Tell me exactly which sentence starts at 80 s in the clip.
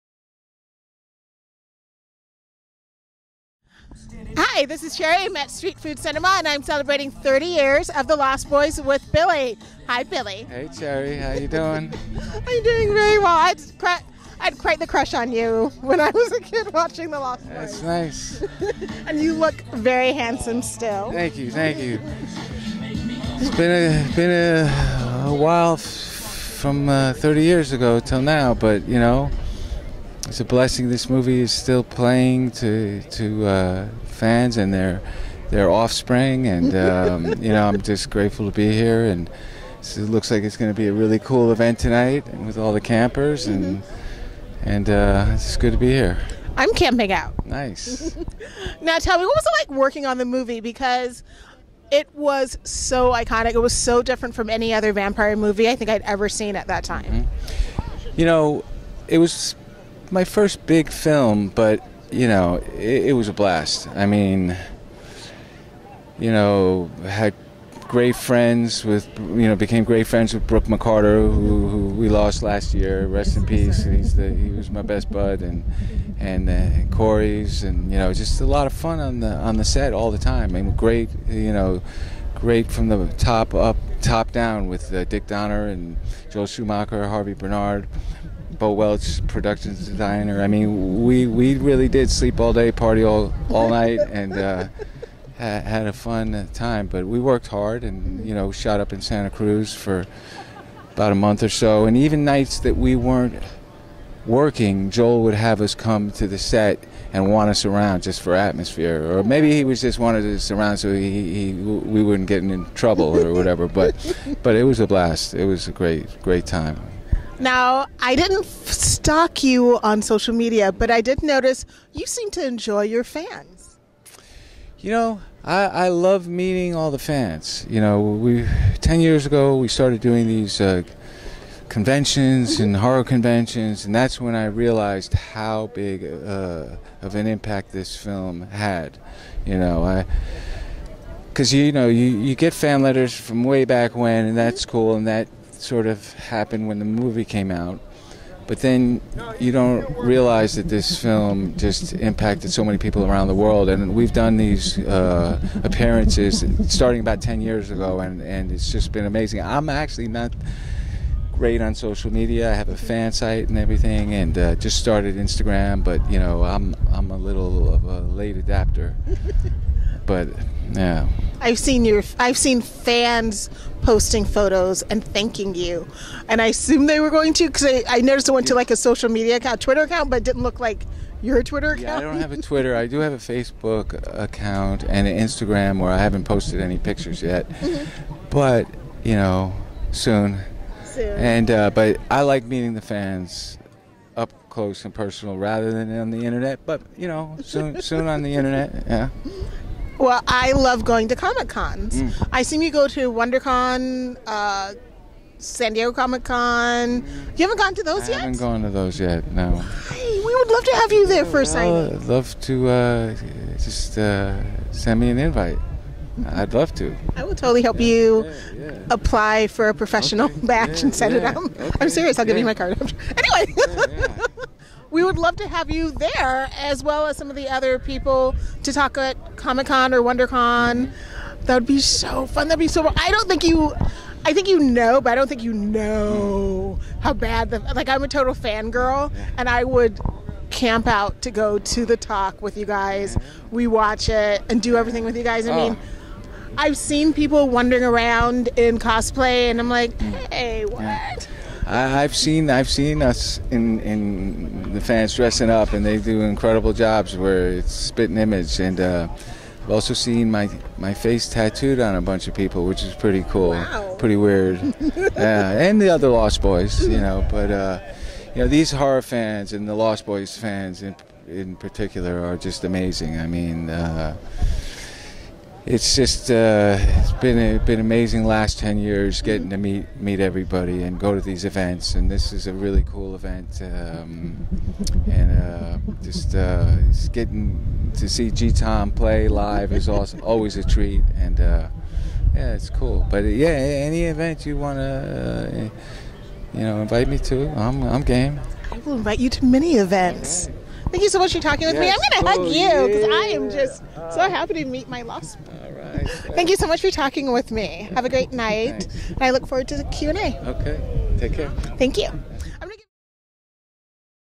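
And great, you know, great from the top up, top down with uh, Dick Donner and Joel Schumacher, Harvey Bernhard.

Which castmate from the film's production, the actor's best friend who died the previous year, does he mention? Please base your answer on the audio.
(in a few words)
Brooke McCarter.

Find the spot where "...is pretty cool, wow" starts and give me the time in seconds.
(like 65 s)
262 s.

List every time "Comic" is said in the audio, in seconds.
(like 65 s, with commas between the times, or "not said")
201 s, 205 s, 229 s.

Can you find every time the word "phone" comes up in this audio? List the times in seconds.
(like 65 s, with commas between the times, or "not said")
not said.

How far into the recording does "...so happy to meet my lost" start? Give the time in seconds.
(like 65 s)
304 s.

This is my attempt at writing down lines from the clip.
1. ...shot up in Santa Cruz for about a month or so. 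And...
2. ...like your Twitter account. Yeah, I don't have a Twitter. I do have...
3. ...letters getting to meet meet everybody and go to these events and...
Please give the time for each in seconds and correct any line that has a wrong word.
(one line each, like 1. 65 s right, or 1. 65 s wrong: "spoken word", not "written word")
1. 98 s right
2. 180 s right
3. 278 s wrong: "years", not "letters".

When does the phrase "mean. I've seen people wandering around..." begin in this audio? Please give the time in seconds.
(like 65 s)
245 s.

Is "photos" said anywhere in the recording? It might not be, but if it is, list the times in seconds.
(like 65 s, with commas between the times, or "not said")
174 s.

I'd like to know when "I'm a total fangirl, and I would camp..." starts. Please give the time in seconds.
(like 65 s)
237 s.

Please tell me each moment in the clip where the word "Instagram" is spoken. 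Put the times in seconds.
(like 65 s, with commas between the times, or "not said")
165 s, 185 s.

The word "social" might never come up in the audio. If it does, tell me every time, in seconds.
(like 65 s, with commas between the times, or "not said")
120 s, 161 s, 178 s.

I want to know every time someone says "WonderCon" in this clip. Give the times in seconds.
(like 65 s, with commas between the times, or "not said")
203 s, 230 s.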